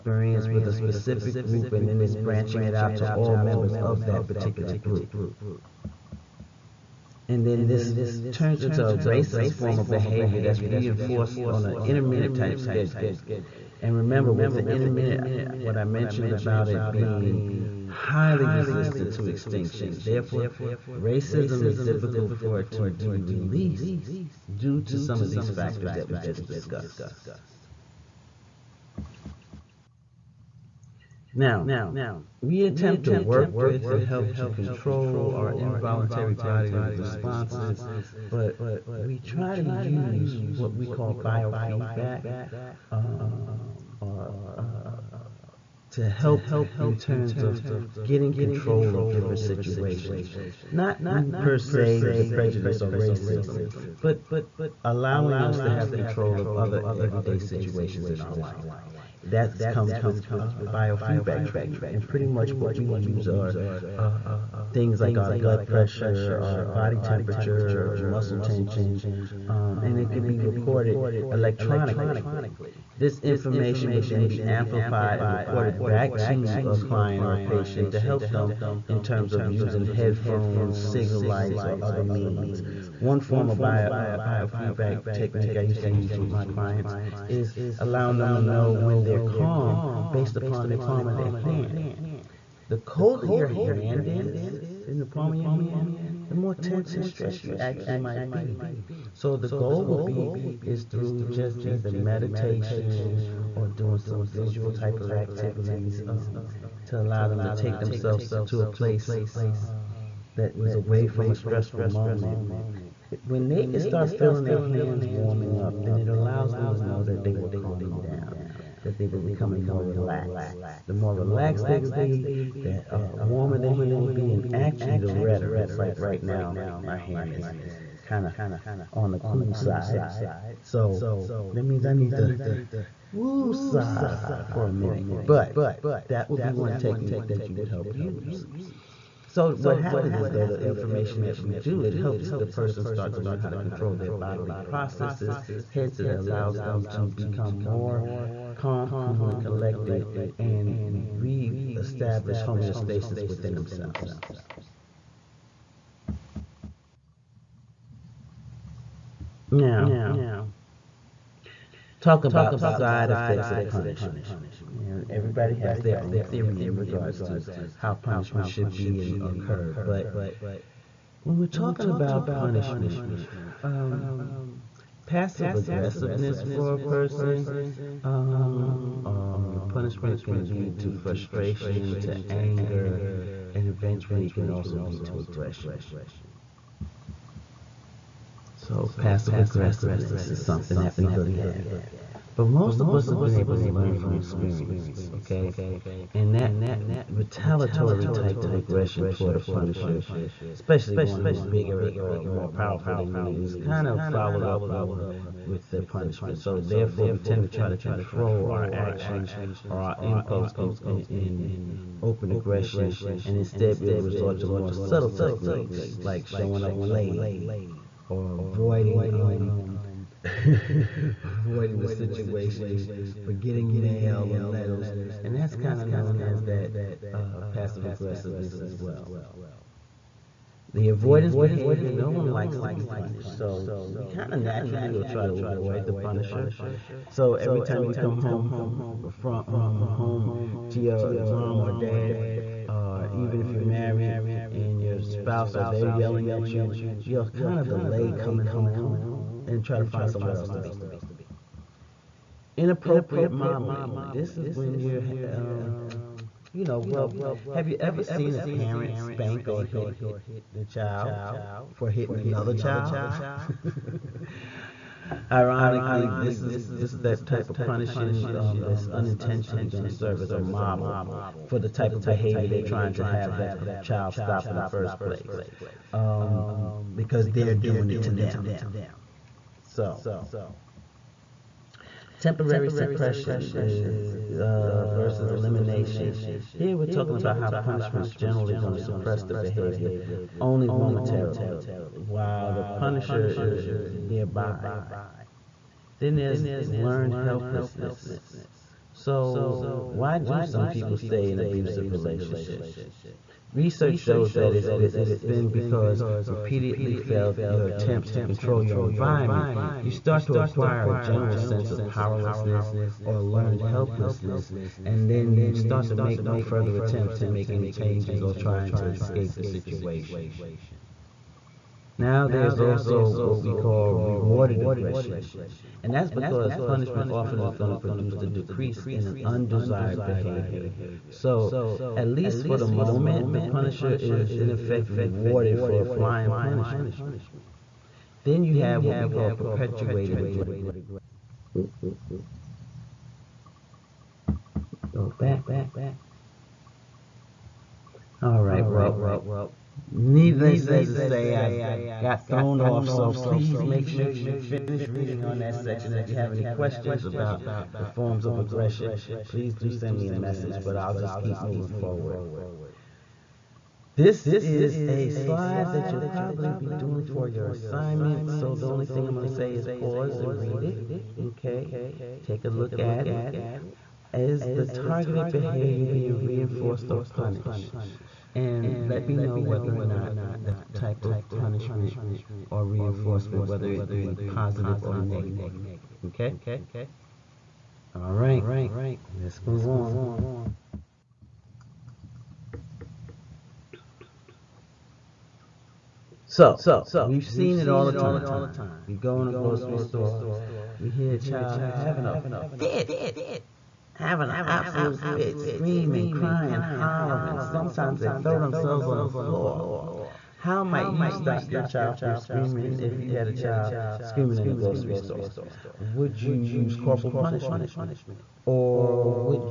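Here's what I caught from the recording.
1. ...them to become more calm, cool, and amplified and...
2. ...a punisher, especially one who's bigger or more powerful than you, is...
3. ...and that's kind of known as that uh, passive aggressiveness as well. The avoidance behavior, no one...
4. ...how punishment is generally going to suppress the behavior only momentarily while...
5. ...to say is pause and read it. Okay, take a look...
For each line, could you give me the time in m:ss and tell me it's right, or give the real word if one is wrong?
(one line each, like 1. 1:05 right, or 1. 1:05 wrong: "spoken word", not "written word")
1. 2:26 wrong: "collected", not "amplified"
2. 3:19 right
3. 3:45 right
4. 4:47 right
5. 6:09 right.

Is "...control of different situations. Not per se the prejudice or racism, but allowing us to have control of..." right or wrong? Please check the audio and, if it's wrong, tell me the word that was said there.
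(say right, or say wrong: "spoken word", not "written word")
right.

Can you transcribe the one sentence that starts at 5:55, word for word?
If you have any questions about the forms of aggression, please do send me a message, but I'll just keep moving forward.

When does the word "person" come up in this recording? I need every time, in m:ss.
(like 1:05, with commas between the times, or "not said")
2:22, 2:56.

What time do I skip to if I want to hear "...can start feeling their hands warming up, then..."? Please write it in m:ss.
1:53.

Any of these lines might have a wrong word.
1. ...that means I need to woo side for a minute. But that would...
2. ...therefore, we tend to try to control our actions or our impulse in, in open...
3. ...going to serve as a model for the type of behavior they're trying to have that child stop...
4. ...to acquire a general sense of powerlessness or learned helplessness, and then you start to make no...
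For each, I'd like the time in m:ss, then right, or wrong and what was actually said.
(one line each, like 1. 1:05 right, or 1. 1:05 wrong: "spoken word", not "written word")
1. 2:11 right
2. 3:26 right
3. 4:29 right
4. 5:10 right.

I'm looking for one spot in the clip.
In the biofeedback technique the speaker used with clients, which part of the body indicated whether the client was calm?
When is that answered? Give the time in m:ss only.
1:30.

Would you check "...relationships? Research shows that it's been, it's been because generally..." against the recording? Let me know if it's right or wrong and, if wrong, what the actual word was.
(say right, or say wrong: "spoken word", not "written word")
wrong: "repeatedly", not "generally".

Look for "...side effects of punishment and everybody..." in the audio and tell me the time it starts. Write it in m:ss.
2:42.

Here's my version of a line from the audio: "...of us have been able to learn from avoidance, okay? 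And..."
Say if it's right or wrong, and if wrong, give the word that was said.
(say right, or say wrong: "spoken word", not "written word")
wrong: "experience", not "avoidance".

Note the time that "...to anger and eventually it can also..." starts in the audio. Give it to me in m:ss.
3:01.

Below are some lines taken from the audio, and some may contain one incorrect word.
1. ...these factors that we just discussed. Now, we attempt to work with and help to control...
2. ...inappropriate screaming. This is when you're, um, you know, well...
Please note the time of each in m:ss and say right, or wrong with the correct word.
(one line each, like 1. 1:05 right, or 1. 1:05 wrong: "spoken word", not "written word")
1. 0:25 right
2. 4:12 wrong: "modeling", not "screaming".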